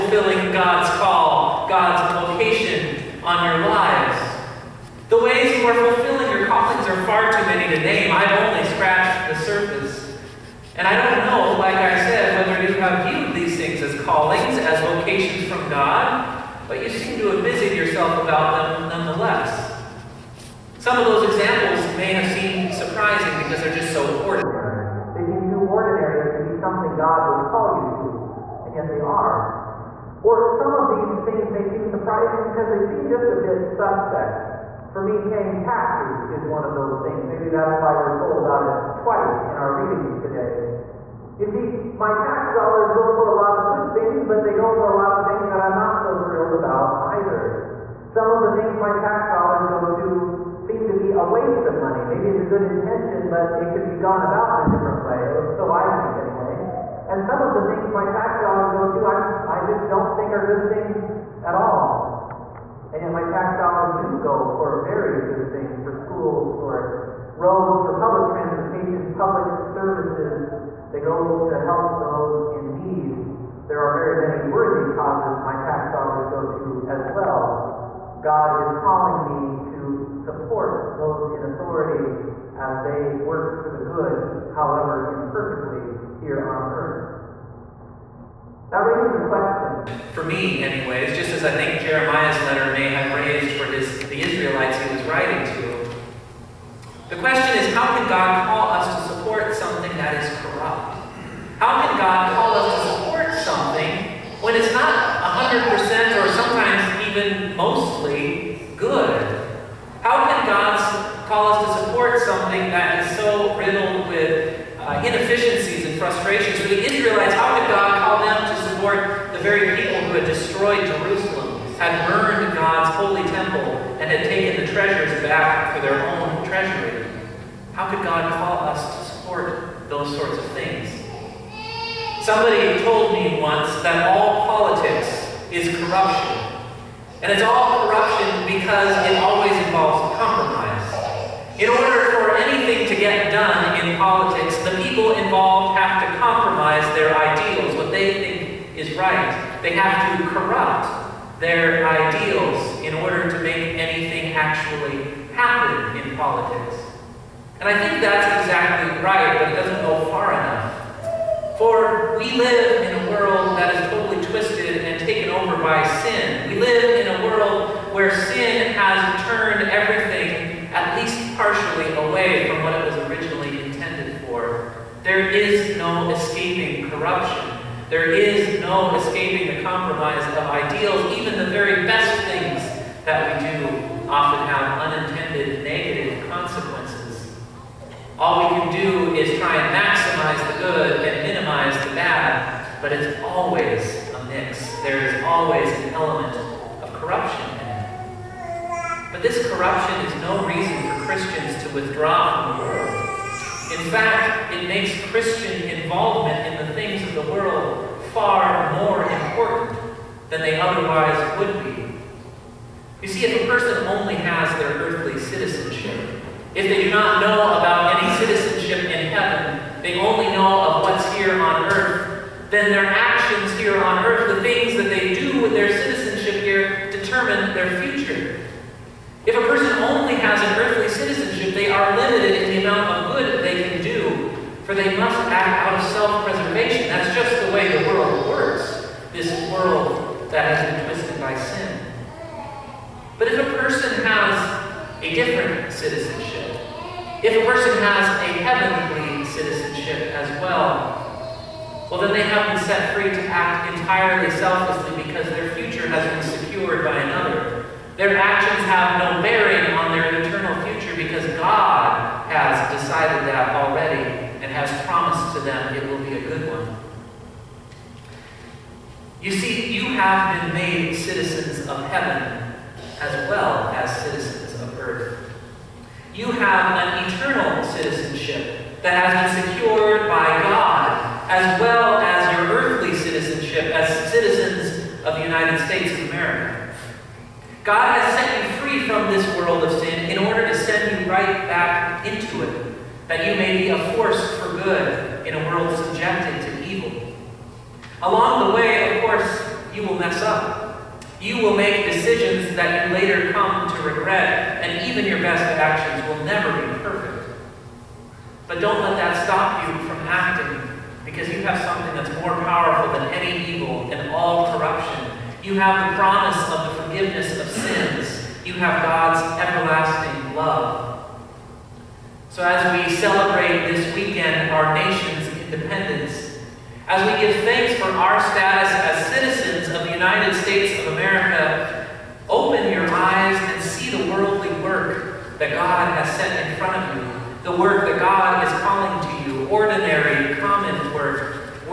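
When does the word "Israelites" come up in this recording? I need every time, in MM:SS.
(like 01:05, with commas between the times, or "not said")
01:34, 01:56.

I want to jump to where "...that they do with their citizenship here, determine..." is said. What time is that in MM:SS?
03:44.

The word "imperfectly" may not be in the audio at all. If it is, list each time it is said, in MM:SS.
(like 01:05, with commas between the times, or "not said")
01:25.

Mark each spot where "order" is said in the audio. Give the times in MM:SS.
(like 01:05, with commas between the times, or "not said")
02:21, 02:32, 04:50.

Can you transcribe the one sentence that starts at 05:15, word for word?
You have the promise of the forgiveness of sins.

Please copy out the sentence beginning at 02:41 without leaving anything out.
For we live in a world that is totally twisted and taken over by sin.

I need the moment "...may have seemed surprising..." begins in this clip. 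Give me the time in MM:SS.
00:21.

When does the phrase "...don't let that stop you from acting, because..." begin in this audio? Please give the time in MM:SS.
05:08.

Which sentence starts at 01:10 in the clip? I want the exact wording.
They go to help those in need.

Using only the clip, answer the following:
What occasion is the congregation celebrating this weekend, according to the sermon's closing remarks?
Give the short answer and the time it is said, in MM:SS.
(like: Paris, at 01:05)
Our nation's independence, at 05:24.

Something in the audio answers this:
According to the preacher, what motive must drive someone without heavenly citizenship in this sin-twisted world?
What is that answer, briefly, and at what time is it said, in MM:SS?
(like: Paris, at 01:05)
Self preservation, at 03:55.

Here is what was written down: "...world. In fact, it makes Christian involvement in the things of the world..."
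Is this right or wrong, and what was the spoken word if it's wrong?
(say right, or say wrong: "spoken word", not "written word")
right.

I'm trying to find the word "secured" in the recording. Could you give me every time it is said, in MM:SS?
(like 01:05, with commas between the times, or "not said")
04:16, 04:39.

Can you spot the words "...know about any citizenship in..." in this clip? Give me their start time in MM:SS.
03:37.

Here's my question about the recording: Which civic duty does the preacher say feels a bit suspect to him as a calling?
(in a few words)
Paying taxes.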